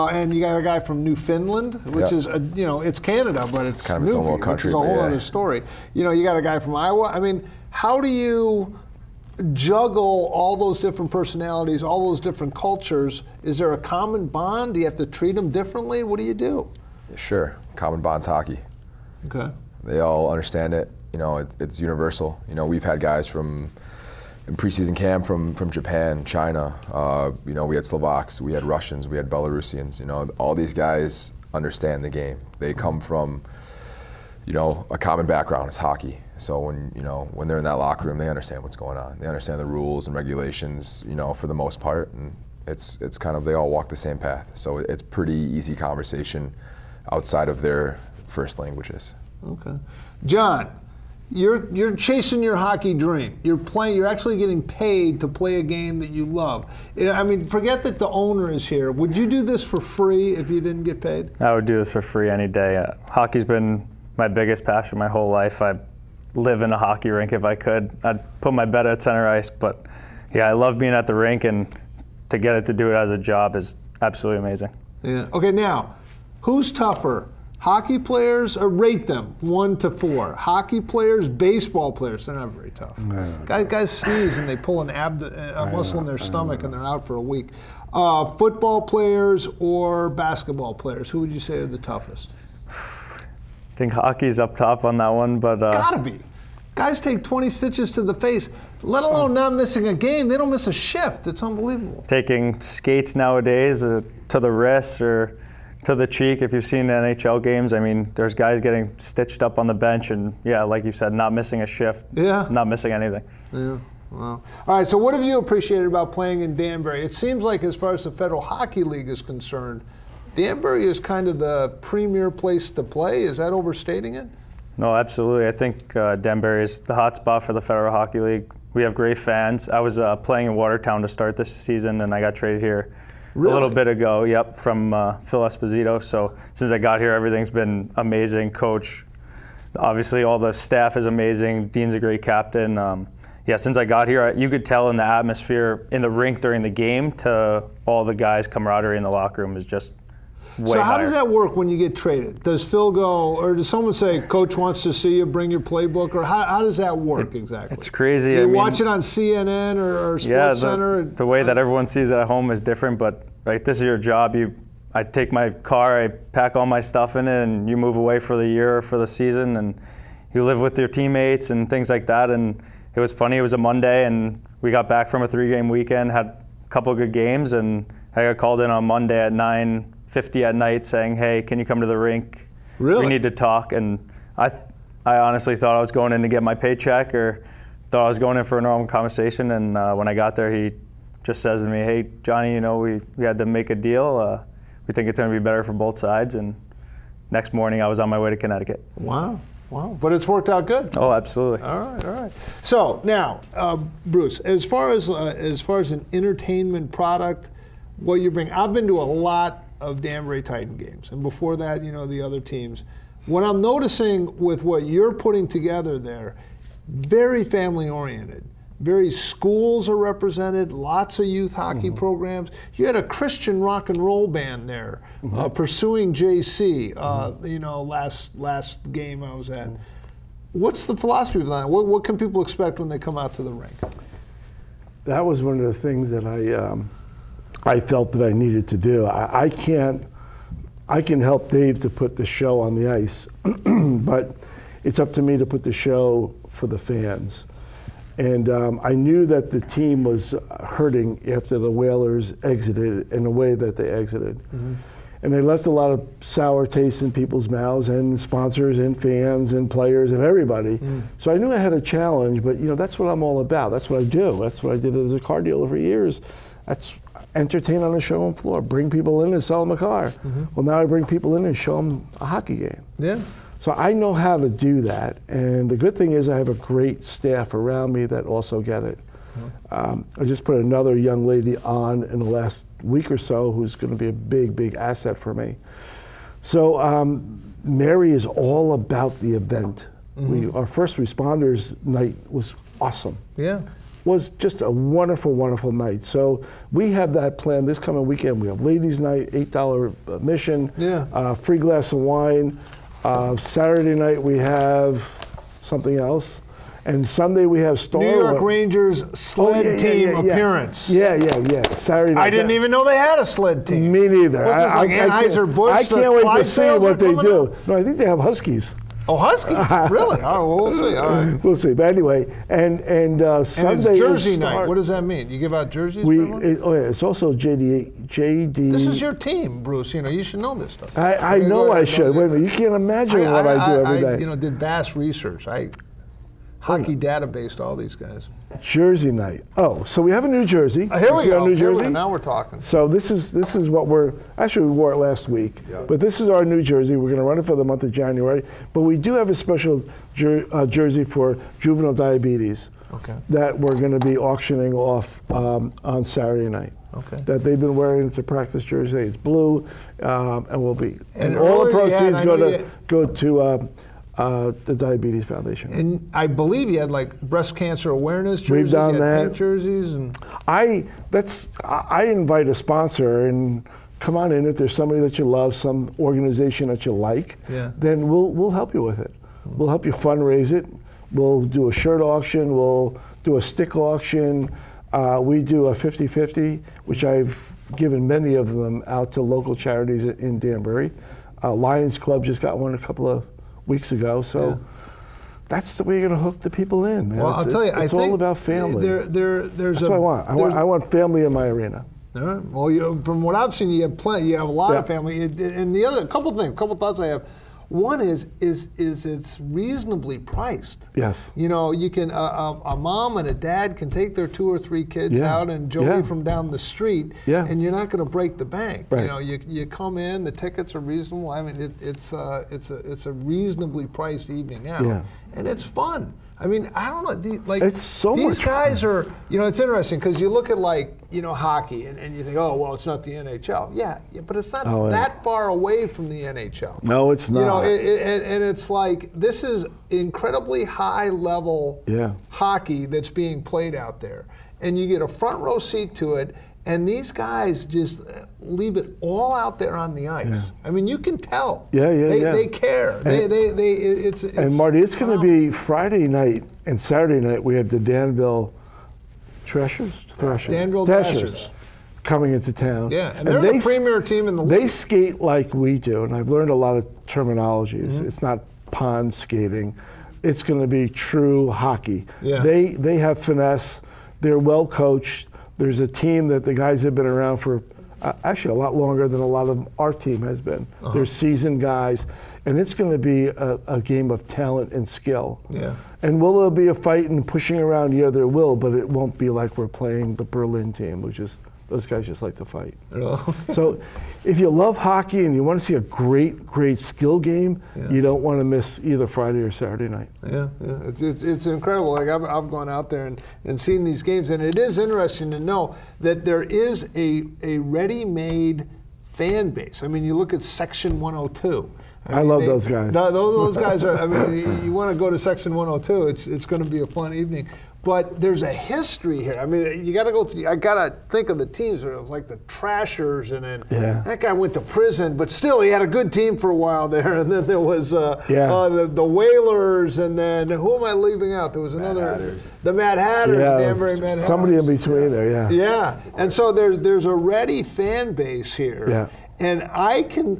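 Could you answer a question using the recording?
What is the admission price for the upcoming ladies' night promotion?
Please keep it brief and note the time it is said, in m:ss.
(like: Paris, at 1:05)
$8, at 4:59.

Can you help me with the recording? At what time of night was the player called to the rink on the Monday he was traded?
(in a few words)
9:50.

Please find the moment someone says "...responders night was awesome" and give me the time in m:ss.
4:50.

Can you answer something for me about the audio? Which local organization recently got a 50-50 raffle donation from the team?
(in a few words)
Lions Club.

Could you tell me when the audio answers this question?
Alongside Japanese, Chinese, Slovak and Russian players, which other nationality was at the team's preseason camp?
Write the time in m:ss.
0:29.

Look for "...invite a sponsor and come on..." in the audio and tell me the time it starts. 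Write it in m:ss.
6:12.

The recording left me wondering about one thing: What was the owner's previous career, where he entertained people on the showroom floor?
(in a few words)
Car dealer.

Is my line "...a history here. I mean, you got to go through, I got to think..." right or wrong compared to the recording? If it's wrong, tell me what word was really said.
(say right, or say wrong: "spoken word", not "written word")
right.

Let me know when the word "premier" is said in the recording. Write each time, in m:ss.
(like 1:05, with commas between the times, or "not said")
2:01, 7:43.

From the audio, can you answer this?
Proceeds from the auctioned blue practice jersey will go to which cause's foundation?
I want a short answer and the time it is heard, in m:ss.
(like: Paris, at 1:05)
Diabetes Foundation, at 6:04.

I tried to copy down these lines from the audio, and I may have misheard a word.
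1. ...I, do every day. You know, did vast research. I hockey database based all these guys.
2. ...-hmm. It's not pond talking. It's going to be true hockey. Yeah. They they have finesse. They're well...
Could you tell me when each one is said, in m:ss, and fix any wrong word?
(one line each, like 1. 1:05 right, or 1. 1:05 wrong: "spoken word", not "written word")
1. 5:33 right
2. 7:47 wrong: "skating", not "talking".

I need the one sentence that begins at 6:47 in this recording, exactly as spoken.
One is is is it's reasonably priced.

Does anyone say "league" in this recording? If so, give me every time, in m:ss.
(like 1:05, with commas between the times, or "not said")
1:58, 2:08, 7:44.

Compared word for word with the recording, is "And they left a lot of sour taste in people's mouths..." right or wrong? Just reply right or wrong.
right.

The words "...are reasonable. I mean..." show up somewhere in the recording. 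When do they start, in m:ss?
7:00.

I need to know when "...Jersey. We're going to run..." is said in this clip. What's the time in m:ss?
5:46.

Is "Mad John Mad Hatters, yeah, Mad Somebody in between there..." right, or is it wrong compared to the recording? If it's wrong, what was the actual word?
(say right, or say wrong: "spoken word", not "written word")
wrong: "The", not "John".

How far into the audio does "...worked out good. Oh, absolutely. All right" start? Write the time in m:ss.
3:20.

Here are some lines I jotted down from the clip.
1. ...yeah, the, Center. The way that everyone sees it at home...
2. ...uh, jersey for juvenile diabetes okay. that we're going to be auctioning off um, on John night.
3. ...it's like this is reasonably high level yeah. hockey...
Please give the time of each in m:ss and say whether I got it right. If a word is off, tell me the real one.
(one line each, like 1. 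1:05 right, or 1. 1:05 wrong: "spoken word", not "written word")
1. 2:40 right
2. 5:50 wrong: "Saturday", not "John"
3. 7:18 wrong: "incredibly", not "reasonably".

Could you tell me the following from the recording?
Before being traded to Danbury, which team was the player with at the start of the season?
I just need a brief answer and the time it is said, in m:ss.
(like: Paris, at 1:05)
Watertown, at 2:10.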